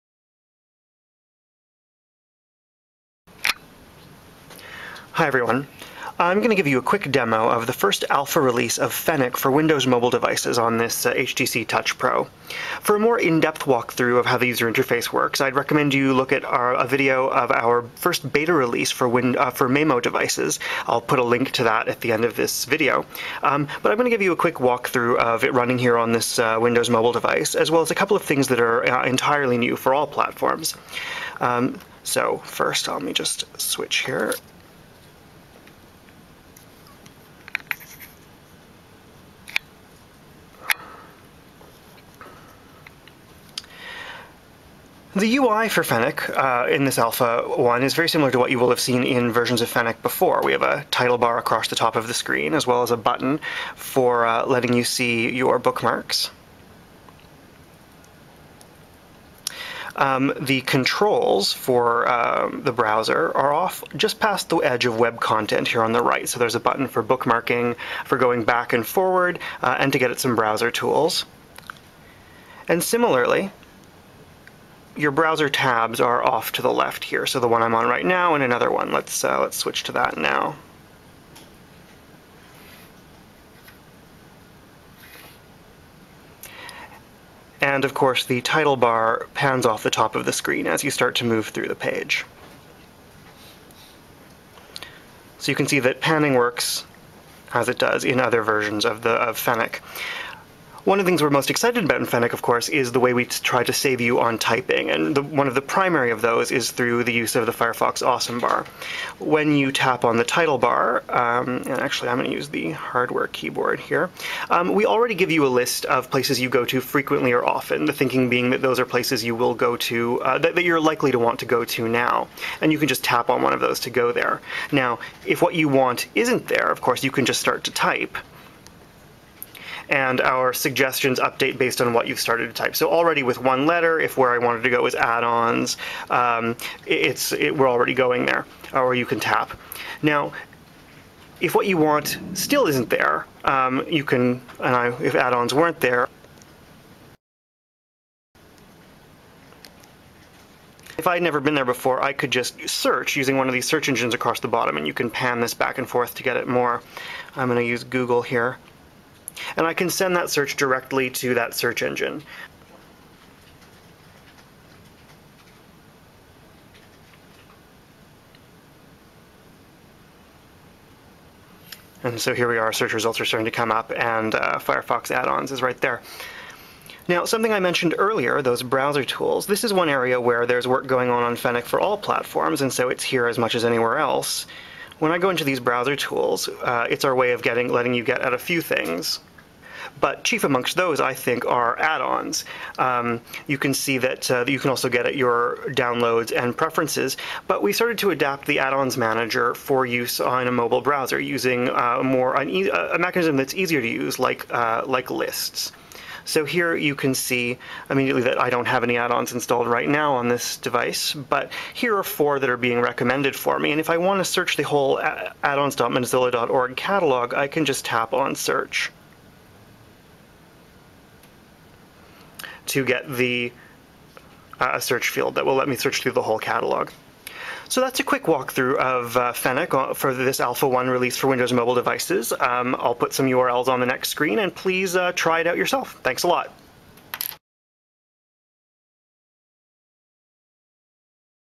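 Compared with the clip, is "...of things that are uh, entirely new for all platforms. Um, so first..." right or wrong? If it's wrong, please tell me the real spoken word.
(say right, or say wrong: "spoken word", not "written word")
right.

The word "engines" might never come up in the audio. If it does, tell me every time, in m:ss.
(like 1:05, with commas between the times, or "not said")
2:33, 2:41.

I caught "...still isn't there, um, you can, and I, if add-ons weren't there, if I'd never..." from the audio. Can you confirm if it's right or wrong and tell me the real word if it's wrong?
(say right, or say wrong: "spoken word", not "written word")
right.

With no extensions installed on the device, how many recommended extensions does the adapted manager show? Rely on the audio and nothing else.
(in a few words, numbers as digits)
4.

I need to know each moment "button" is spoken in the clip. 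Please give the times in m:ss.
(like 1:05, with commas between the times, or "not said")
0:52, 1:06.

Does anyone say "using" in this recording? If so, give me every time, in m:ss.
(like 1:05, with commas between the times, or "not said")
2:33, 3:21.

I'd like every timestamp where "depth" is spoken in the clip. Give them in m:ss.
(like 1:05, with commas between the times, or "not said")
0:13.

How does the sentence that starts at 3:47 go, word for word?
So that's a quick walkthrough of uh, Fennec uh, for this Alpha 1 release for Windows mobile devices.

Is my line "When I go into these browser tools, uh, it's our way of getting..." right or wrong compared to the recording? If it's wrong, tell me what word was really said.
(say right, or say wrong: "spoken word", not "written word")
right.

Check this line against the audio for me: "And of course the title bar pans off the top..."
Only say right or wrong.
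right.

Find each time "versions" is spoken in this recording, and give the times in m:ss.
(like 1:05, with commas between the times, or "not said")
0:49, 1:38.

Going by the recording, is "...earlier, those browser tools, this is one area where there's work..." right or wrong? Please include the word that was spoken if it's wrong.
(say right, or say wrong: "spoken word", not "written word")
right.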